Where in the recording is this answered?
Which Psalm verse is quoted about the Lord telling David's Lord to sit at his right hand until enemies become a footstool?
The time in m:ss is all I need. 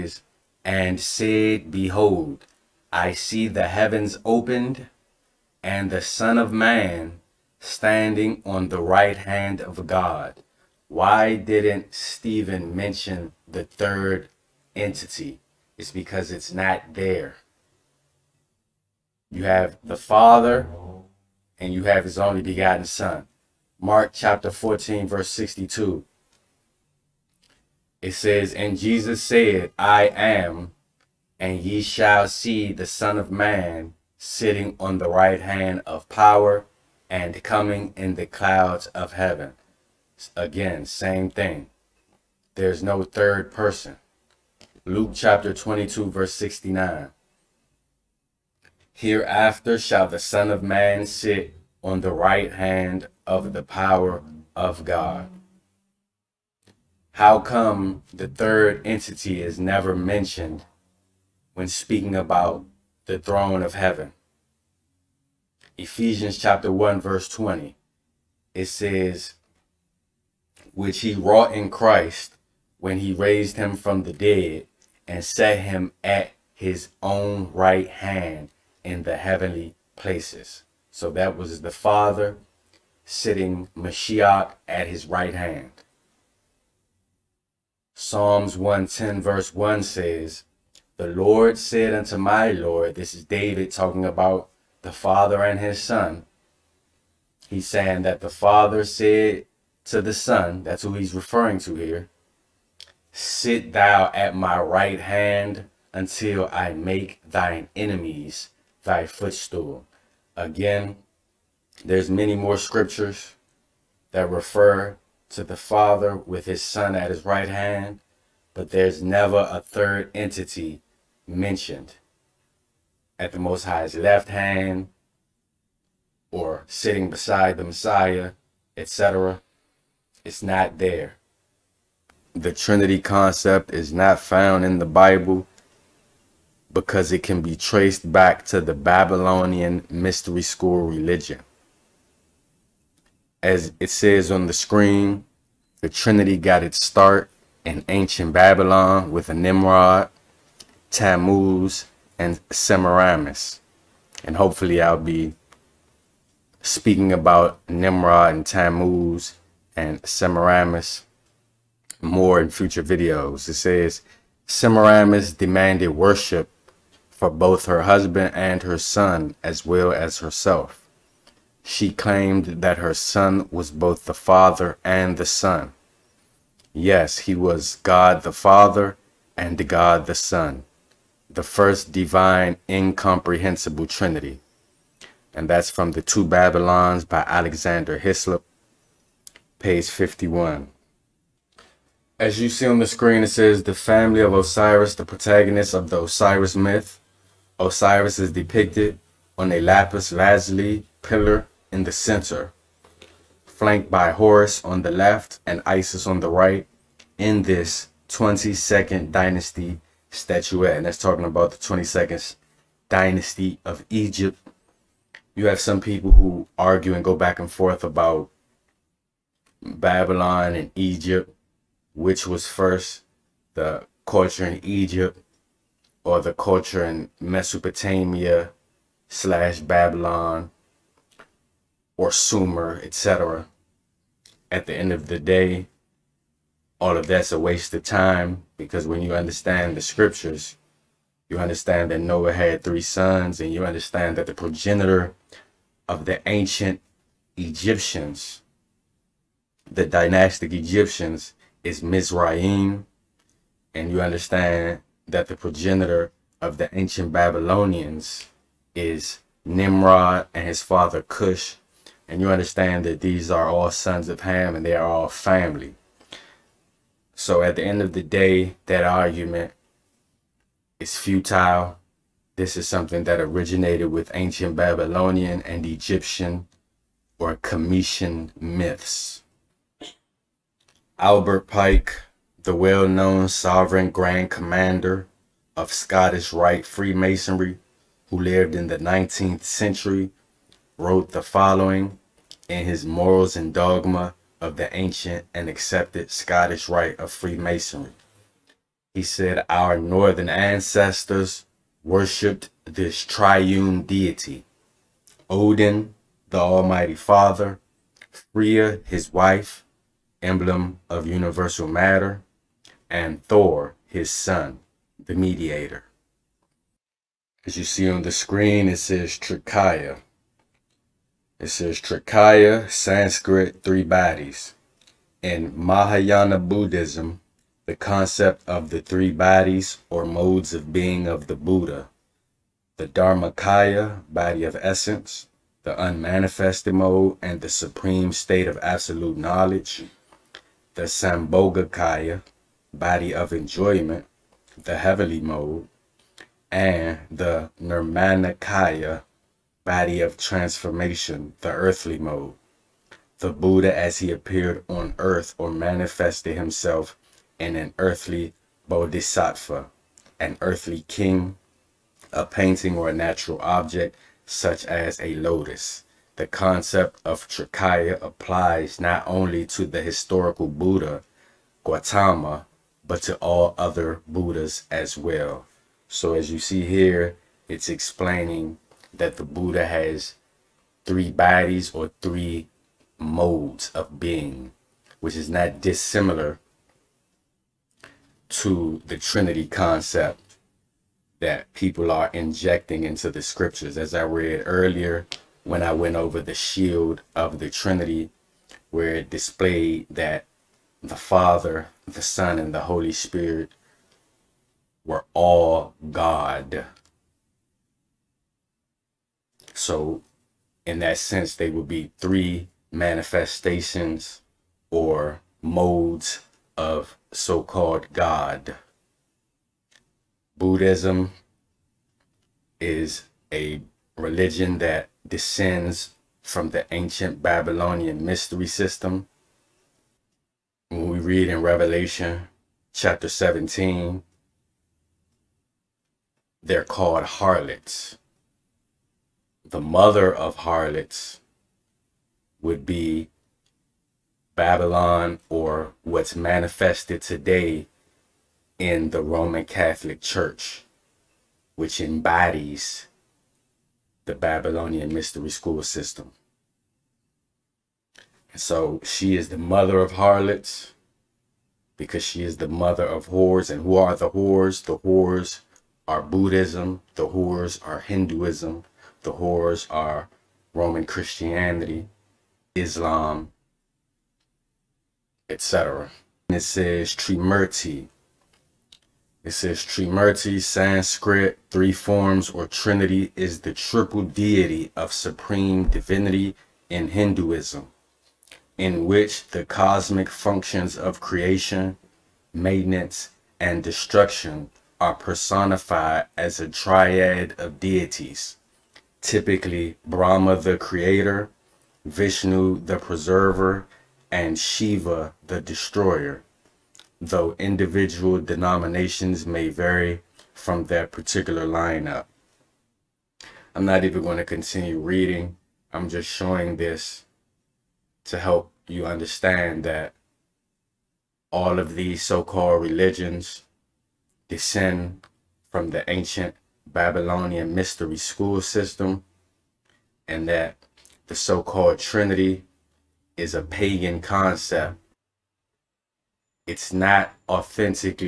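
1:27.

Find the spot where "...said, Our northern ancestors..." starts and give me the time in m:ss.
4:59.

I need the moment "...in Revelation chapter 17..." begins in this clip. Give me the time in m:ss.
7:11.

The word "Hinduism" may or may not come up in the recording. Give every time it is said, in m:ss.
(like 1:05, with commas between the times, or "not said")
7:47, 8:06.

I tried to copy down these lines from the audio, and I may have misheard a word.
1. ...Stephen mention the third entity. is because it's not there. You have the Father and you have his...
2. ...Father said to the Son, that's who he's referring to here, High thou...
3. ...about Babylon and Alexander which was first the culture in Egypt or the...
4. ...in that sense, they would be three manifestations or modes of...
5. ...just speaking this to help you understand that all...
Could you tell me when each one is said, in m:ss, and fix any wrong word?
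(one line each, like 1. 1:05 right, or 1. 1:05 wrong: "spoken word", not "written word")
1. 0:11 right
2. 1:38 wrong: "Sit", not "High"
3. 3:37 wrong: "Egypt", not "Alexander"
4. 6:50 right
5. 8:35 wrong: "showing", not "speaking".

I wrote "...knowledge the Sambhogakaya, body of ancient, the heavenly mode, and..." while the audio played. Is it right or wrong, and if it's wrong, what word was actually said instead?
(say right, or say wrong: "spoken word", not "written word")
wrong: "enjoyment", not "ancient".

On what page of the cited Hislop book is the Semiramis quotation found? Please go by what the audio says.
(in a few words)
51.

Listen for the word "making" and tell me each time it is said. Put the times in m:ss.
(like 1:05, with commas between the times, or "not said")
not said.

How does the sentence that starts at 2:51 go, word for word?
She claimed that her son was both the father and the son.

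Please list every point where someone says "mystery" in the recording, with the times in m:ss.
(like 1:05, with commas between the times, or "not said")
2:19, 7:08, 7:34, 8:47.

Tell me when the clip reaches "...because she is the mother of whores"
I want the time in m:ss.
7:41.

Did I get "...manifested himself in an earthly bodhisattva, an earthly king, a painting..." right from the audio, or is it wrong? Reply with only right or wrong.
right.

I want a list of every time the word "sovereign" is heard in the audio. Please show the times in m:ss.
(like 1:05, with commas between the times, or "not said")
4:43.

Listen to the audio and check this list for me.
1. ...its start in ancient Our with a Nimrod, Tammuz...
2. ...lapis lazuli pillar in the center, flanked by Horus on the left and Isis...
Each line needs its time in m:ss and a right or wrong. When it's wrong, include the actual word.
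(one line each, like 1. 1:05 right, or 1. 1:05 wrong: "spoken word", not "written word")
1. 2:26 wrong: "Babylon", not "Our"
2. 3:19 right.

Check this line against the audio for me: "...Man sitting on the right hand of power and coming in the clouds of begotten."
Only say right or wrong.
wrong.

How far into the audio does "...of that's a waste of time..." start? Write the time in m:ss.
3:56.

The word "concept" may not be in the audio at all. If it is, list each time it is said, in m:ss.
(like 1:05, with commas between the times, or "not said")
2:12, 5:27, 6:06, 6:29, 8:54.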